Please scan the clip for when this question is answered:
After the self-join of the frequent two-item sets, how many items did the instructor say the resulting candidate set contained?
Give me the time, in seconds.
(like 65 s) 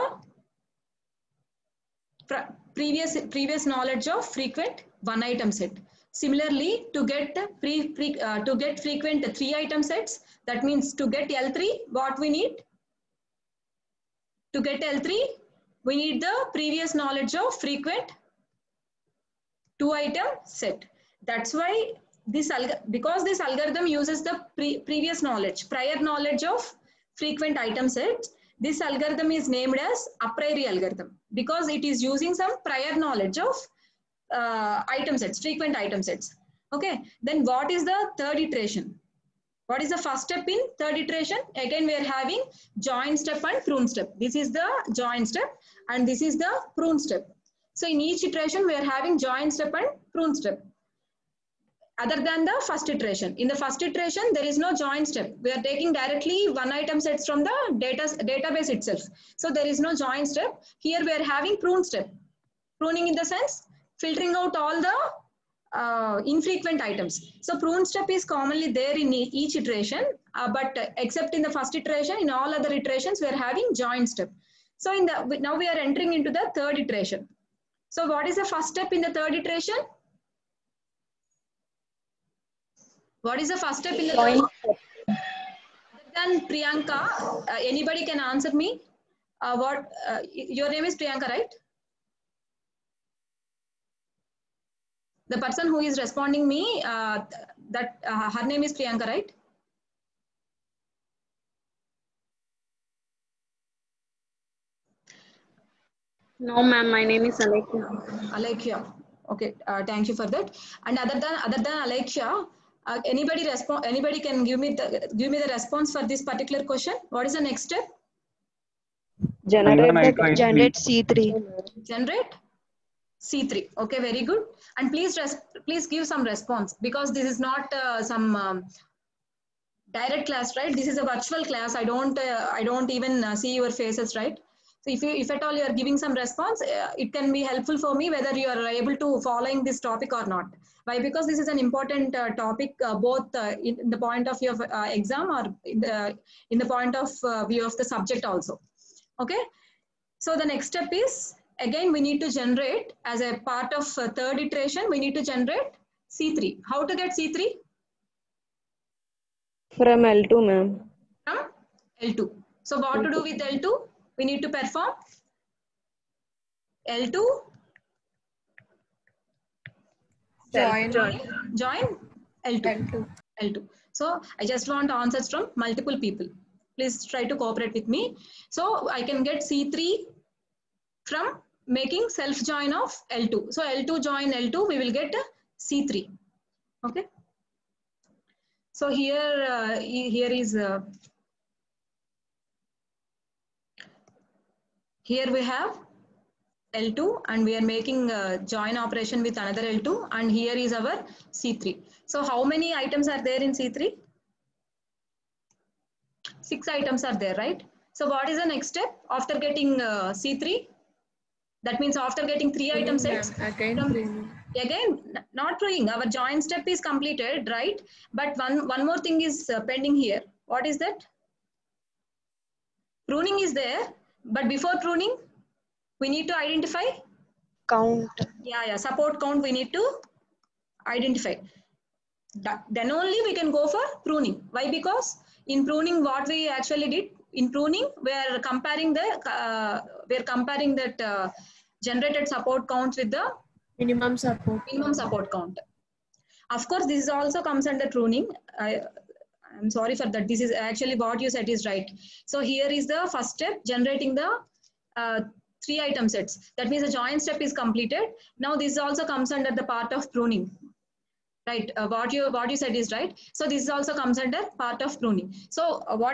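206 s.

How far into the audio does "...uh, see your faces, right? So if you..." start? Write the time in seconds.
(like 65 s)
133 s.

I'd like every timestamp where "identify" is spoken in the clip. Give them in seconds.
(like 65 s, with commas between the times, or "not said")
226 s, 230 s.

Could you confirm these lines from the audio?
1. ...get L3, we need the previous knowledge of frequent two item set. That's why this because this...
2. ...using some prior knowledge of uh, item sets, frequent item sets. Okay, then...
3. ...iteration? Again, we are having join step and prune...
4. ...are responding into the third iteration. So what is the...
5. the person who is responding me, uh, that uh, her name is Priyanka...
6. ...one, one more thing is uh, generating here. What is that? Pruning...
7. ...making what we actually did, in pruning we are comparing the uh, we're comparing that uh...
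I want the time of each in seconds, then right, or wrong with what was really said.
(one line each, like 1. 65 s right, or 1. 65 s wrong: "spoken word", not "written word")
1. 14 s right
2. 32 s right
3. 40 s right
4. 75 s wrong: "entering", not "responding"
5. 95 s right
6. 218 s wrong: "pending", not "generating"
7. 235 s wrong: "pruning", not "making".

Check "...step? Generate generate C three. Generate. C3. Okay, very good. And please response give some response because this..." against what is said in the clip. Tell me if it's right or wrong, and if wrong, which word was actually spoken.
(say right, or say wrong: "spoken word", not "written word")
wrong: "please", not "response".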